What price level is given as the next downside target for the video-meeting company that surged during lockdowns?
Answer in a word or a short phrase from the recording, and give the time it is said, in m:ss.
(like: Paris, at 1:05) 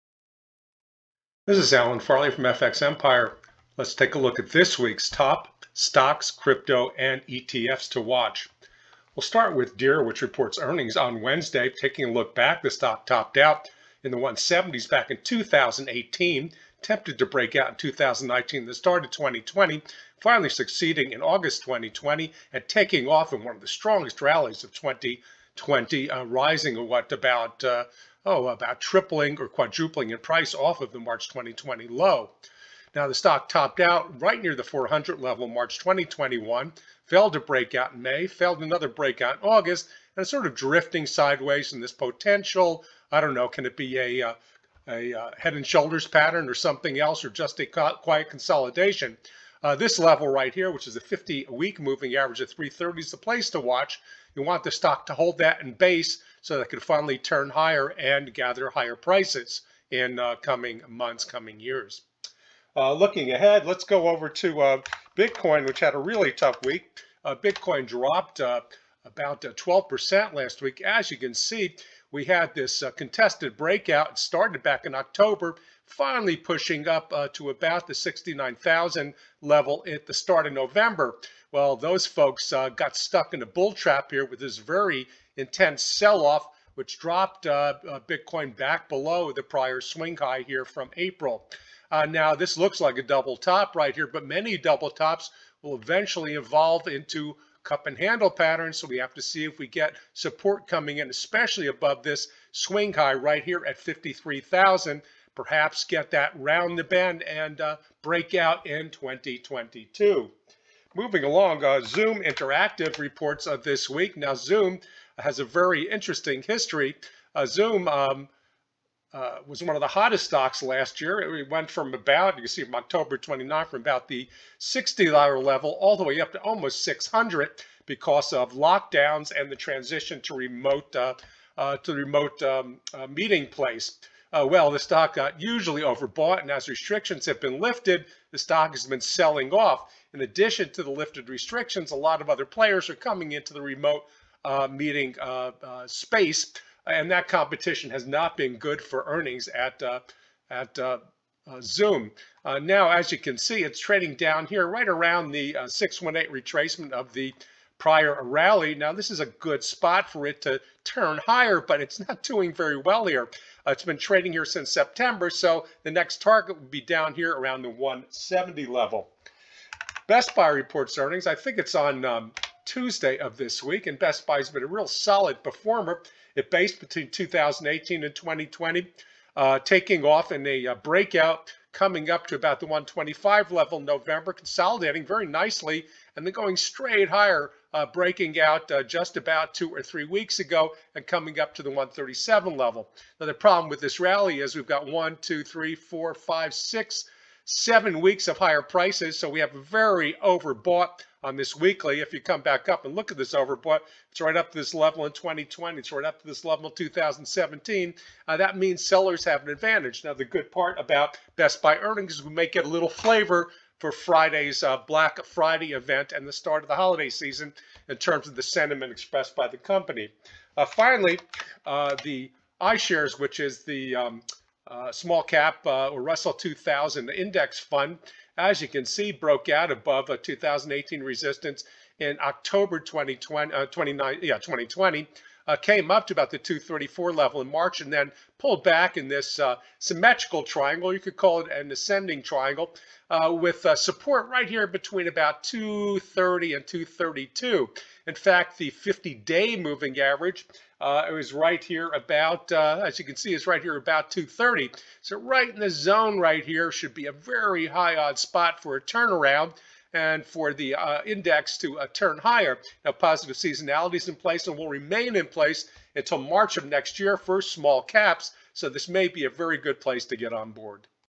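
170, at 2:47.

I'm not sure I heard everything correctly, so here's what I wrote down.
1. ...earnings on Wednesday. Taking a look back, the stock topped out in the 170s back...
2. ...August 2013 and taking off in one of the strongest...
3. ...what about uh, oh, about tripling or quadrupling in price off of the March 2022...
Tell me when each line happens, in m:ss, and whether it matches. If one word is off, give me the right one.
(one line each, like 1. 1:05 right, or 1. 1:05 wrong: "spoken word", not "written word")
1. 0:10 right
2. 0:21 wrong: "2020", not "2013"
3. 0:26 wrong: "2020", not "2022".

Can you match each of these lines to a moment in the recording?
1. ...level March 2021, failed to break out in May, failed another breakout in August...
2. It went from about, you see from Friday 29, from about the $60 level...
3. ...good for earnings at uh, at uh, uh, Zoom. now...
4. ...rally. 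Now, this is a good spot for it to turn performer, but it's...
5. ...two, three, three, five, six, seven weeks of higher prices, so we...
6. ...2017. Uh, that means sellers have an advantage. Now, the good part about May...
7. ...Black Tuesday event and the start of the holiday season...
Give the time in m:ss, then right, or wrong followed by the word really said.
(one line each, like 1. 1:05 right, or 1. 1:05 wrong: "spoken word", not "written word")
1. 0:35 right
2. 2:01 wrong: "October", not "Friday"
3. 2:28 right
4. 2:38 wrong: "higher", not "performer"
5. 3:15 wrong: "four", not "three"
6. 3:26 wrong: "Best", not "May"
7. 3:34 wrong: "Friday", not "Tuesday".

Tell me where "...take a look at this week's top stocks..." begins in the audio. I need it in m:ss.
0:03.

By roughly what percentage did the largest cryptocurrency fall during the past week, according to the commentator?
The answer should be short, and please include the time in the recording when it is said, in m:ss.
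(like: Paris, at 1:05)
12%, at 1:09.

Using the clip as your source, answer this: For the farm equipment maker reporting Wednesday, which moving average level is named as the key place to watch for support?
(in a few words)
330.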